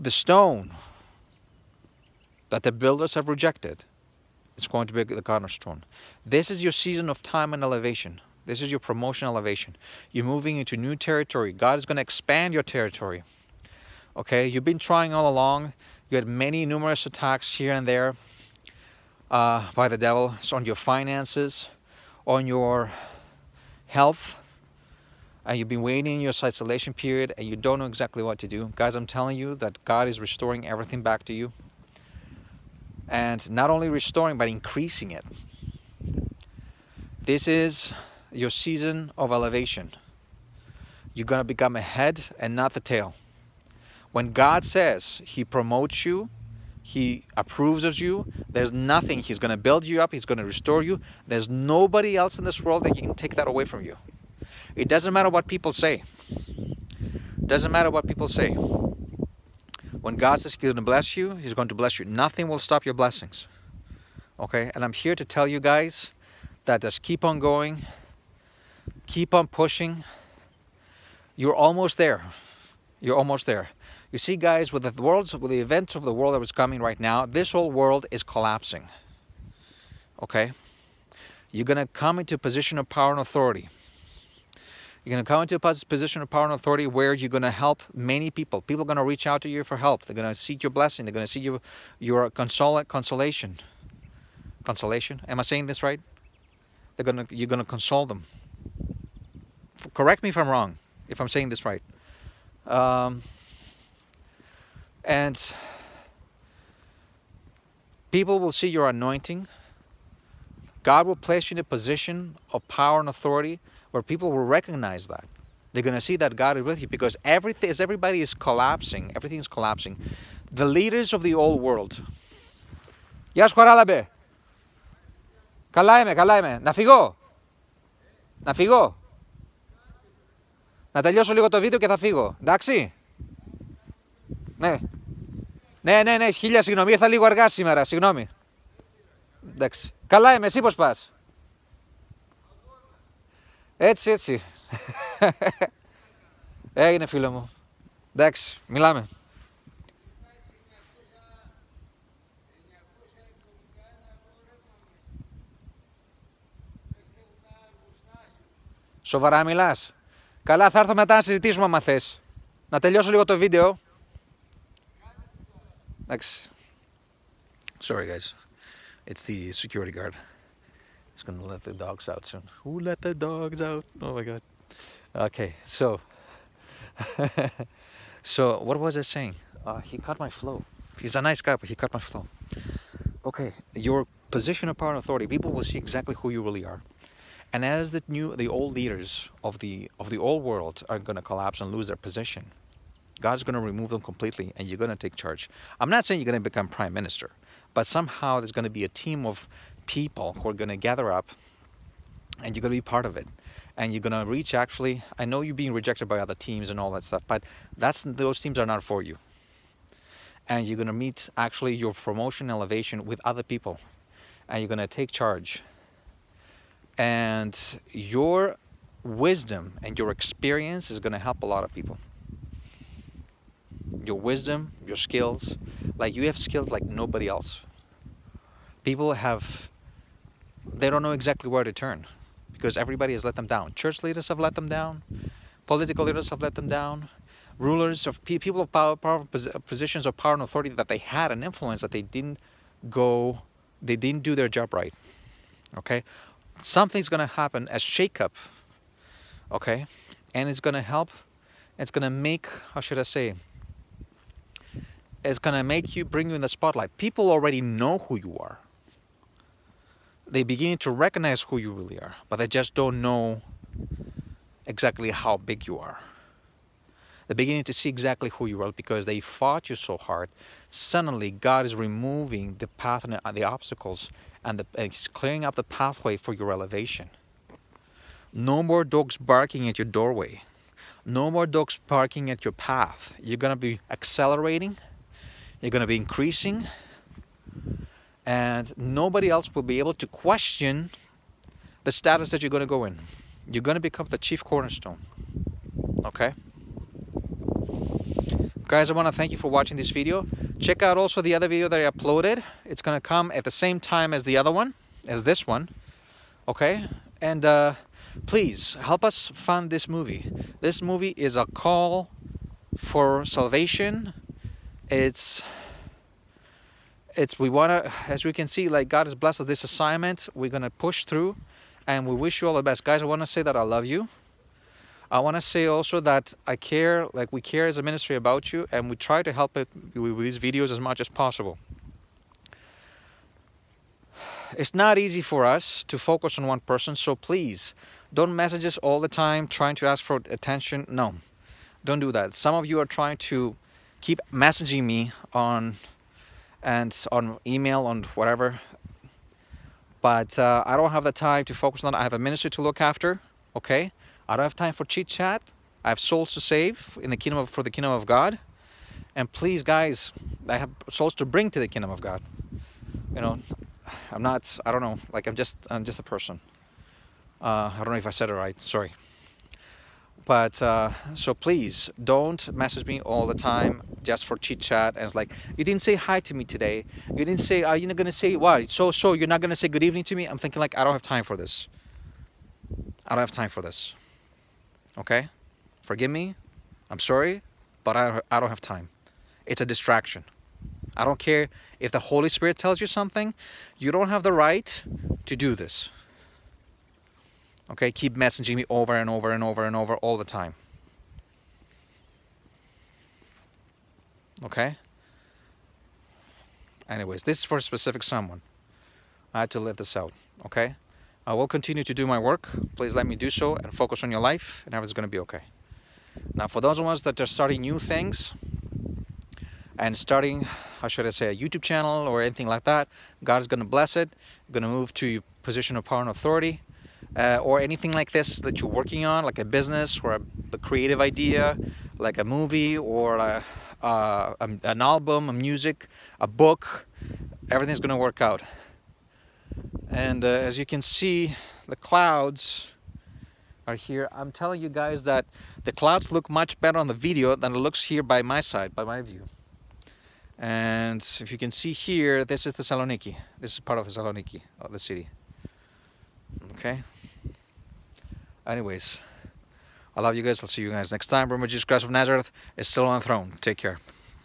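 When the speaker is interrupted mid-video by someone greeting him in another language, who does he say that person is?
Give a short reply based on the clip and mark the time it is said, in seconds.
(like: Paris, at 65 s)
the security guard, at 169 s.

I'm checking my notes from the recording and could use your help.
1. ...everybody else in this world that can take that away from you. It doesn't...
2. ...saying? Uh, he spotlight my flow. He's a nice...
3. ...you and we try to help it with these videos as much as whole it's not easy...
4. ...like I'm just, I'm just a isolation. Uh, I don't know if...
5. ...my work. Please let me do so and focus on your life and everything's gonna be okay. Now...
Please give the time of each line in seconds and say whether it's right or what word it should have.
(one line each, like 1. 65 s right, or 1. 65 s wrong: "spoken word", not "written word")
1. 51 s wrong: "nobody", not "everybody"
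2. 179 s wrong: "caught", not "spotlight"
3. 328 s wrong: "possible", not "whole"
4. 365 s wrong: "person", not "isolation"
5. 412 s right.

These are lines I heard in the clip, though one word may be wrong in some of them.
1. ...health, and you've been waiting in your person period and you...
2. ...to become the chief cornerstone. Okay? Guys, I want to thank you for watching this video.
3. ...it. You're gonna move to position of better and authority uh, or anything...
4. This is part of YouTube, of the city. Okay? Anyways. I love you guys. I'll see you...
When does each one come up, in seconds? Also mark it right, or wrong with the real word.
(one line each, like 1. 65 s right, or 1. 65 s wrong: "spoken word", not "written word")
1. 23 s wrong: "isolation", not "person"
2. 293 s right
3. 423 s wrong: "power", not "better"
4. 453 s wrong: "Thessaloniki", not "YouTube".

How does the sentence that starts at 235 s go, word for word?
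Political leaders have let them down.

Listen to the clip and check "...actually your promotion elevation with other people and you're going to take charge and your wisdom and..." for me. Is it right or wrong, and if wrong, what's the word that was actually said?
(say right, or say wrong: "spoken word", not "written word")
right.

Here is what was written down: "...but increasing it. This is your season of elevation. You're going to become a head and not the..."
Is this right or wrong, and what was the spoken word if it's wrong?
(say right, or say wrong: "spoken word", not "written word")
right.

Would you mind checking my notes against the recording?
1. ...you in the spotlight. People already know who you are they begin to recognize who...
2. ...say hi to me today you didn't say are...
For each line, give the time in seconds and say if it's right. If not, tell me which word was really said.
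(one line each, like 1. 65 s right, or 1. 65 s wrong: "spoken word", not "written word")
1. 256 s right
2. 375 s right.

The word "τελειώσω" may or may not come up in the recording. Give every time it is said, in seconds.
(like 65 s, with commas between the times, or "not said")
131 s, 162 s.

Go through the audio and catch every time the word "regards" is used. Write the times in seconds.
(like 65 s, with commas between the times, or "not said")
not said.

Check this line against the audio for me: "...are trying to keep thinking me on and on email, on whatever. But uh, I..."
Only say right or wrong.
wrong.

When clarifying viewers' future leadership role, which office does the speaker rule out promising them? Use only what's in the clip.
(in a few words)
prime minister.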